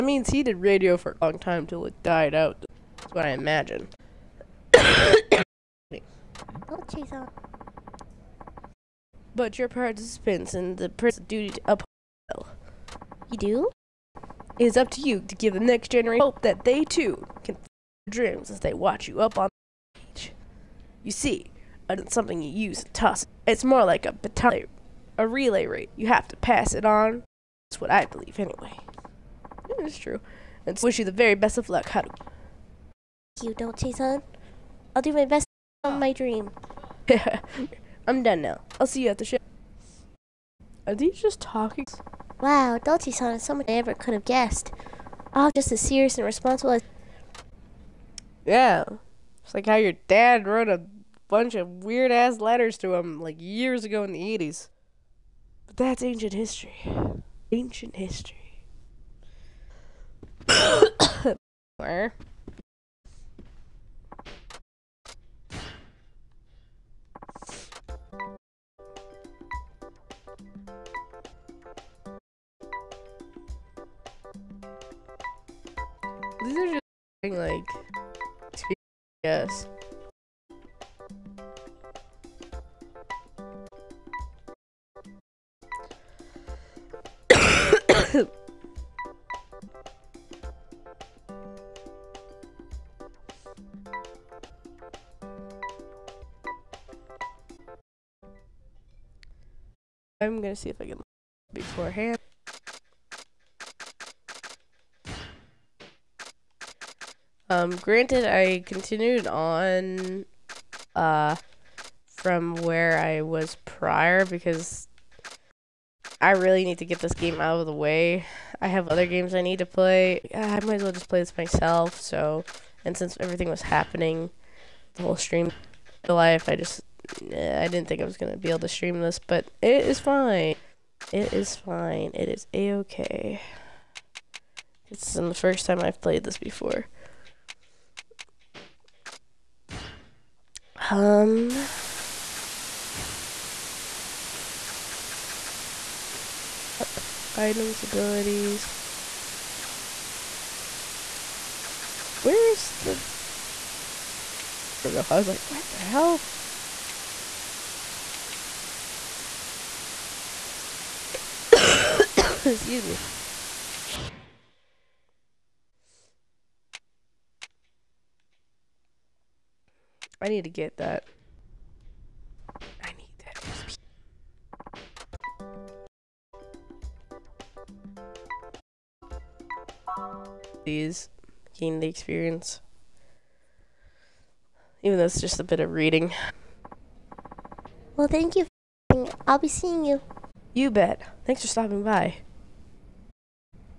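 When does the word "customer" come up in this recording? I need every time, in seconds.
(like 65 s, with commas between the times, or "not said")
not said.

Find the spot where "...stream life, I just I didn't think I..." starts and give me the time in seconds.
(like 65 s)
125 s.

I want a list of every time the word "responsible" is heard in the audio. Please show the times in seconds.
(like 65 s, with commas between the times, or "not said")
46 s.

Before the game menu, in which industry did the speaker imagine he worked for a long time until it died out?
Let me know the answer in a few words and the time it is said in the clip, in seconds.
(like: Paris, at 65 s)
radio, at 0 s.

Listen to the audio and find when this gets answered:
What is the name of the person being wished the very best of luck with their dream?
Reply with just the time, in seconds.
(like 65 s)
31 s.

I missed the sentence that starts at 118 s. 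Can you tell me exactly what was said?
I have other games I need to play.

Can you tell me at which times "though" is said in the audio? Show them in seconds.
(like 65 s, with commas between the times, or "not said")
184 s.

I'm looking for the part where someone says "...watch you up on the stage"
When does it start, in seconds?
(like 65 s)
18 s.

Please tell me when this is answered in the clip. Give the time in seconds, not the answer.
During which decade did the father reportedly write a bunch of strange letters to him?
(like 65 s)
54 s.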